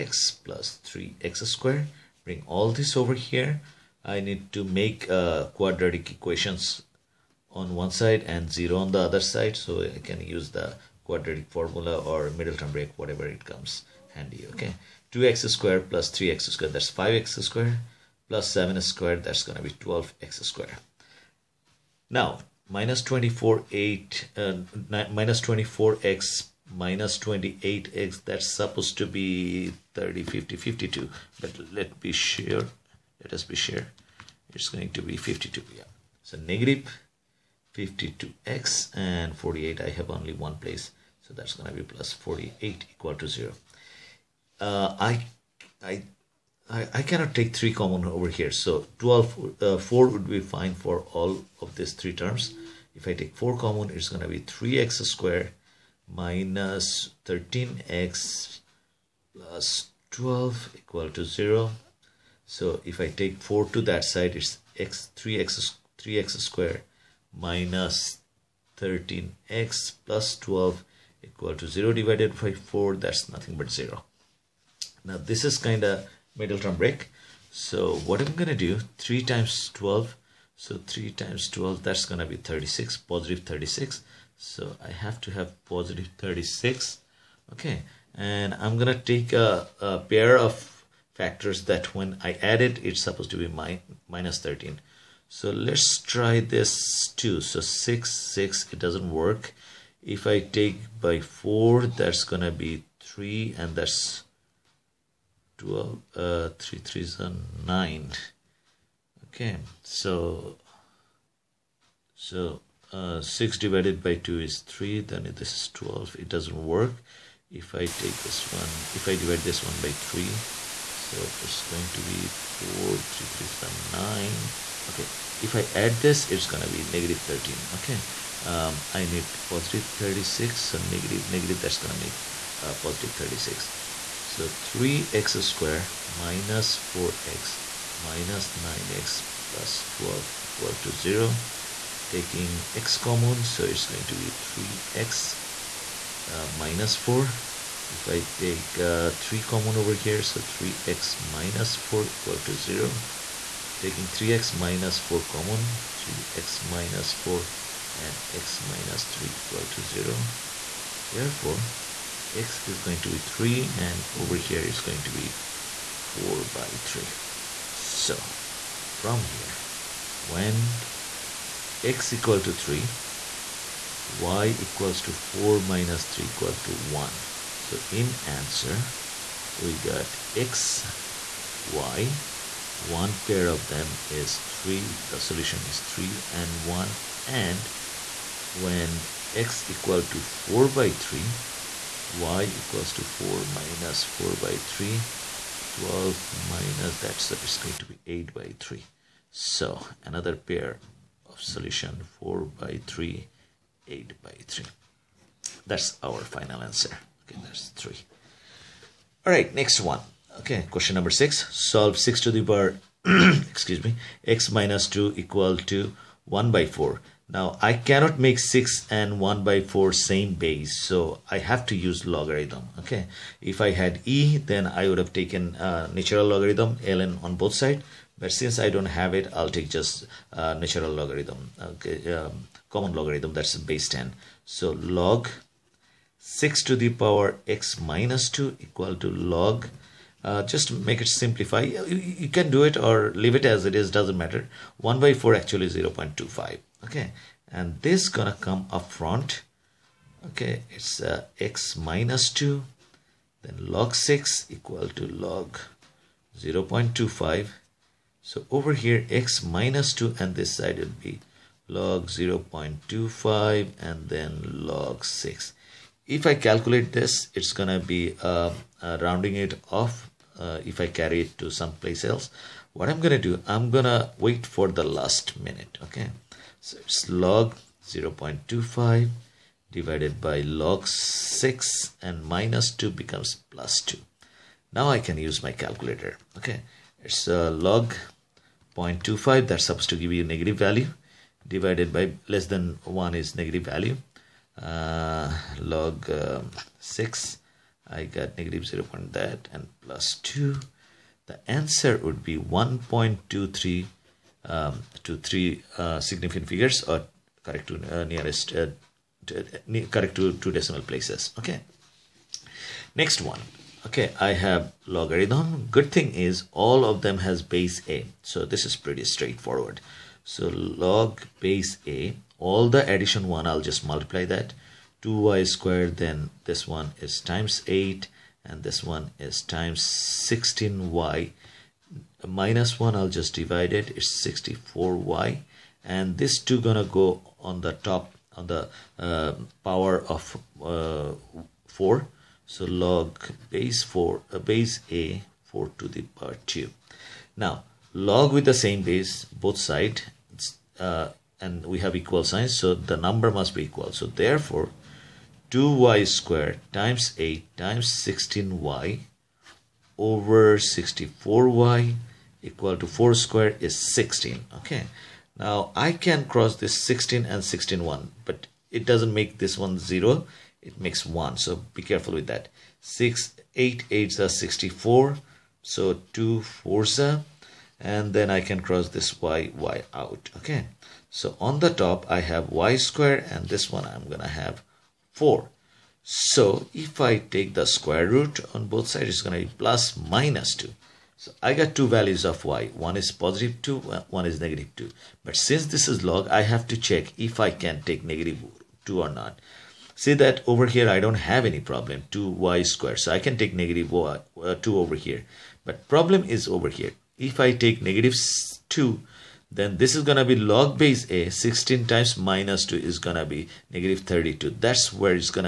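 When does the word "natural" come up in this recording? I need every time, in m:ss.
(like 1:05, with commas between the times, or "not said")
3:45, 3:50.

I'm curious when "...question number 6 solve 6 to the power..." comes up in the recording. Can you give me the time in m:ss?
3:30.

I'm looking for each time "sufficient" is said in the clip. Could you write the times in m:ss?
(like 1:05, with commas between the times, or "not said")
not said.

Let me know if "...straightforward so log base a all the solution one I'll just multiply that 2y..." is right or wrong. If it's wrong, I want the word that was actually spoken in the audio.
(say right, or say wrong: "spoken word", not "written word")
wrong: "addition", not "solution".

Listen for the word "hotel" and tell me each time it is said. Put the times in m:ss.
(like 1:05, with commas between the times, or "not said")
not said.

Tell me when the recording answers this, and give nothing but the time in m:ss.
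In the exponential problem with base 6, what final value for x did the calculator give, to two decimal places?
5:02.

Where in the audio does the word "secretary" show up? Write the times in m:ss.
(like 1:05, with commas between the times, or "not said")
not said.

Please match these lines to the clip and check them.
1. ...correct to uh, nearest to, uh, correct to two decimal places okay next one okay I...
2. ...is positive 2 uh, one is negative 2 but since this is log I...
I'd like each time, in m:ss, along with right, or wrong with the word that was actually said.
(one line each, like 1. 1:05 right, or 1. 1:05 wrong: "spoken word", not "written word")
1. 5:07 right
2. 6:32 right.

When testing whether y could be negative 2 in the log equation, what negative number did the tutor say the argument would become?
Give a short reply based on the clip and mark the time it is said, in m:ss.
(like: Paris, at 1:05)
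-32, at 6:53.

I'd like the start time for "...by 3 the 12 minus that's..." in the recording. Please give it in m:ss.
3:14.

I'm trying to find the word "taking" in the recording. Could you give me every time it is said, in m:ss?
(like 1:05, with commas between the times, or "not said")
2:22, 2:33.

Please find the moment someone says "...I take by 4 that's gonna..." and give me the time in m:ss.
1:40.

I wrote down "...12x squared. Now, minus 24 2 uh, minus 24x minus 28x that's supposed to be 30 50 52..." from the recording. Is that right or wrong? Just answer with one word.
wrong.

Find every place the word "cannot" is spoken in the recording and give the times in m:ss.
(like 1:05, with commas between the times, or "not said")
0:47, 3:37.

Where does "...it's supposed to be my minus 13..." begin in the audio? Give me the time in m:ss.
1:32.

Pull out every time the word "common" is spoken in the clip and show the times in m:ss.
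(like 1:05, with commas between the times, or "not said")
0:47, 0:53, 2:22, 2:29, 2:35, 3:52.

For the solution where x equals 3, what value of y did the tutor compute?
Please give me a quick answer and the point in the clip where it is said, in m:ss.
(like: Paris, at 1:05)
1, at 2:54.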